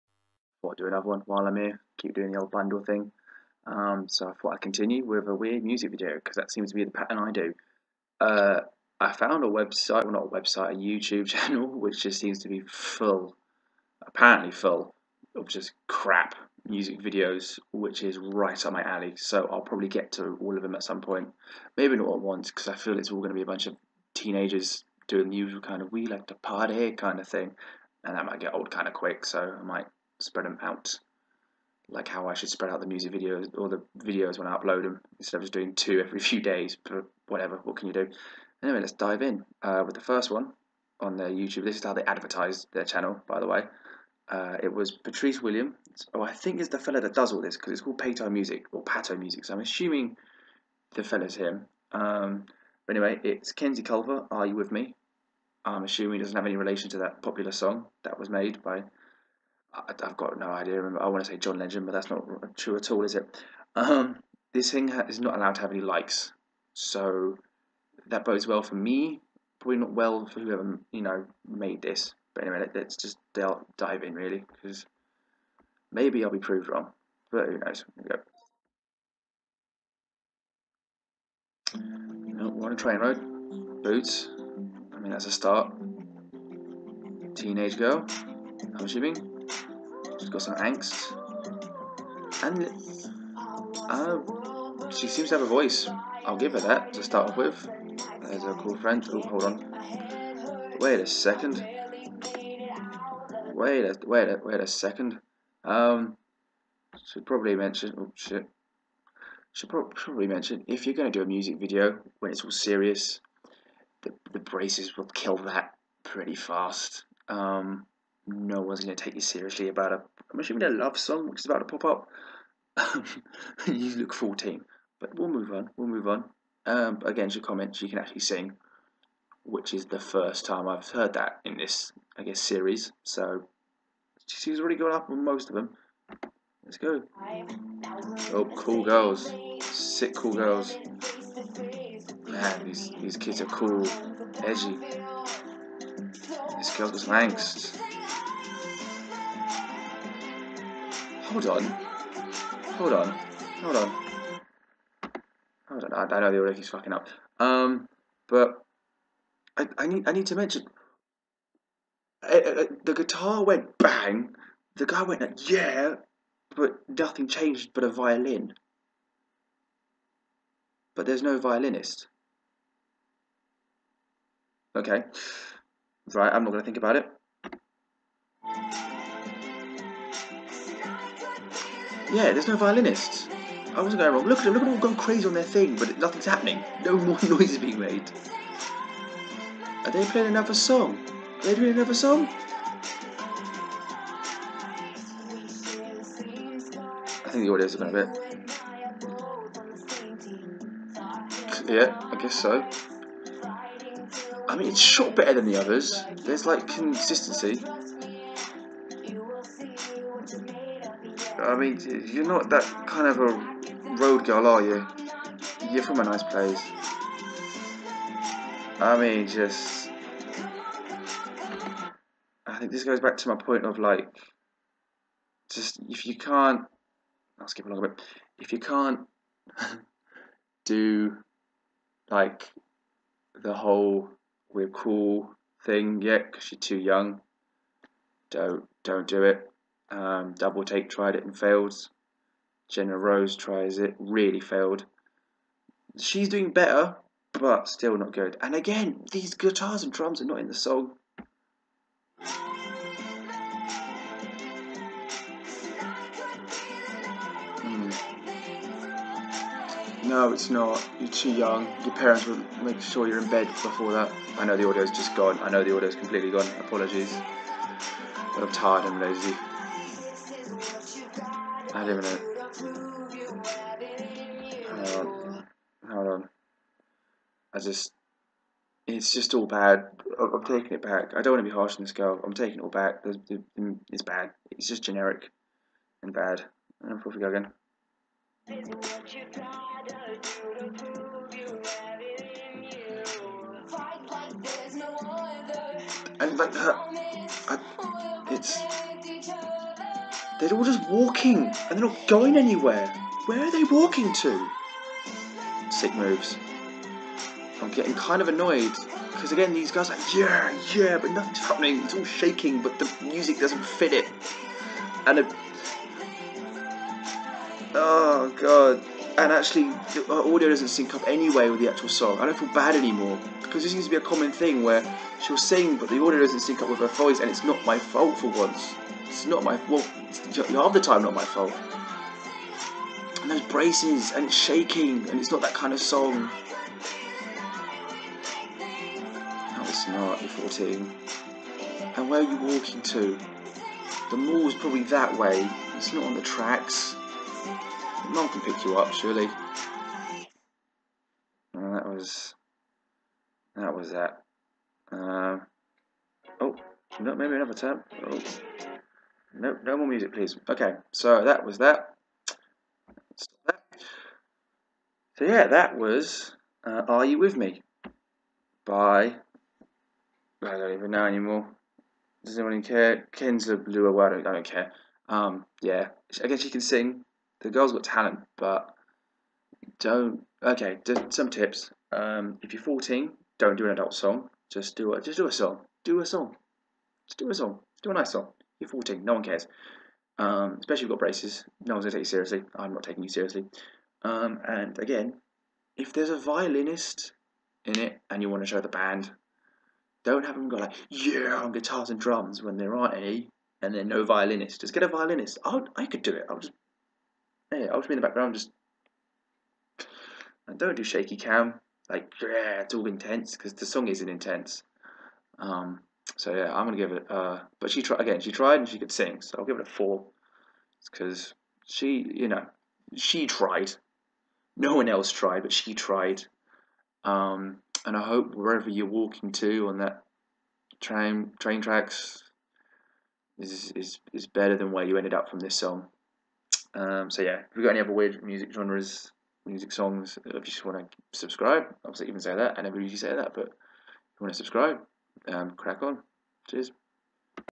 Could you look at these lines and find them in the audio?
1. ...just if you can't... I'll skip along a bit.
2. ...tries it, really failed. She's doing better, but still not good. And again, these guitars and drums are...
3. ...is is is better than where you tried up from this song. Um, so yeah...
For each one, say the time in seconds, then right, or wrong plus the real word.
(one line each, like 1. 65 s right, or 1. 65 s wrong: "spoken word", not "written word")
1. 225 s right
2. 243 s right
3. 433 s wrong: "ended", not "tried".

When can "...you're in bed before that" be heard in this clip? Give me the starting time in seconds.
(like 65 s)
263 s.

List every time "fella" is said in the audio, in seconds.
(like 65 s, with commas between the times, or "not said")
46 s, 51 s.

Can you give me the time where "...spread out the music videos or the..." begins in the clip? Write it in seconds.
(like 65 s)
32 s.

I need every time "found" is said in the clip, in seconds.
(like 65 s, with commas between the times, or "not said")
9 s.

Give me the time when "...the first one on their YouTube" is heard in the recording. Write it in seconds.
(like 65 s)
39 s.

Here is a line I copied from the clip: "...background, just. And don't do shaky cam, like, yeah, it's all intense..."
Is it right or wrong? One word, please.
right.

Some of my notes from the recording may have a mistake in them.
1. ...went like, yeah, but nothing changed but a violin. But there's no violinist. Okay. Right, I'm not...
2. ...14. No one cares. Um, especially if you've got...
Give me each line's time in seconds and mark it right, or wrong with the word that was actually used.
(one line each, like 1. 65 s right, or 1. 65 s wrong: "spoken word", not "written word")
1. 165 s right
2. 388 s right.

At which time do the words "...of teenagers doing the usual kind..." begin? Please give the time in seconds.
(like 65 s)
23 s.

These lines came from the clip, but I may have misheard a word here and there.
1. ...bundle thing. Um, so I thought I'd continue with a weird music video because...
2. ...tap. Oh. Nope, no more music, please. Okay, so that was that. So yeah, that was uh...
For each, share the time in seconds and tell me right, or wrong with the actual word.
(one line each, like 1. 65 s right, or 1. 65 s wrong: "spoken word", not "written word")
1. 2 s right
2. 357 s right.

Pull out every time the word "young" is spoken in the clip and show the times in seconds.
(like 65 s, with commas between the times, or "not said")
236 s, 261 s.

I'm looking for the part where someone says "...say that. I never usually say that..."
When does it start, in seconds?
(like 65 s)
442 s.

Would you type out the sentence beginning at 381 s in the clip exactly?
Um, if you're 14, don't do an adult song.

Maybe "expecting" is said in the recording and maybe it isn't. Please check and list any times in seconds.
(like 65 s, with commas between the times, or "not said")
not said.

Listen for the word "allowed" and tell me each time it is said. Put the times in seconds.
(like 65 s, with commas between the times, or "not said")
65 s.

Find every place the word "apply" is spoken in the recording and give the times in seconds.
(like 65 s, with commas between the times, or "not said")
not said.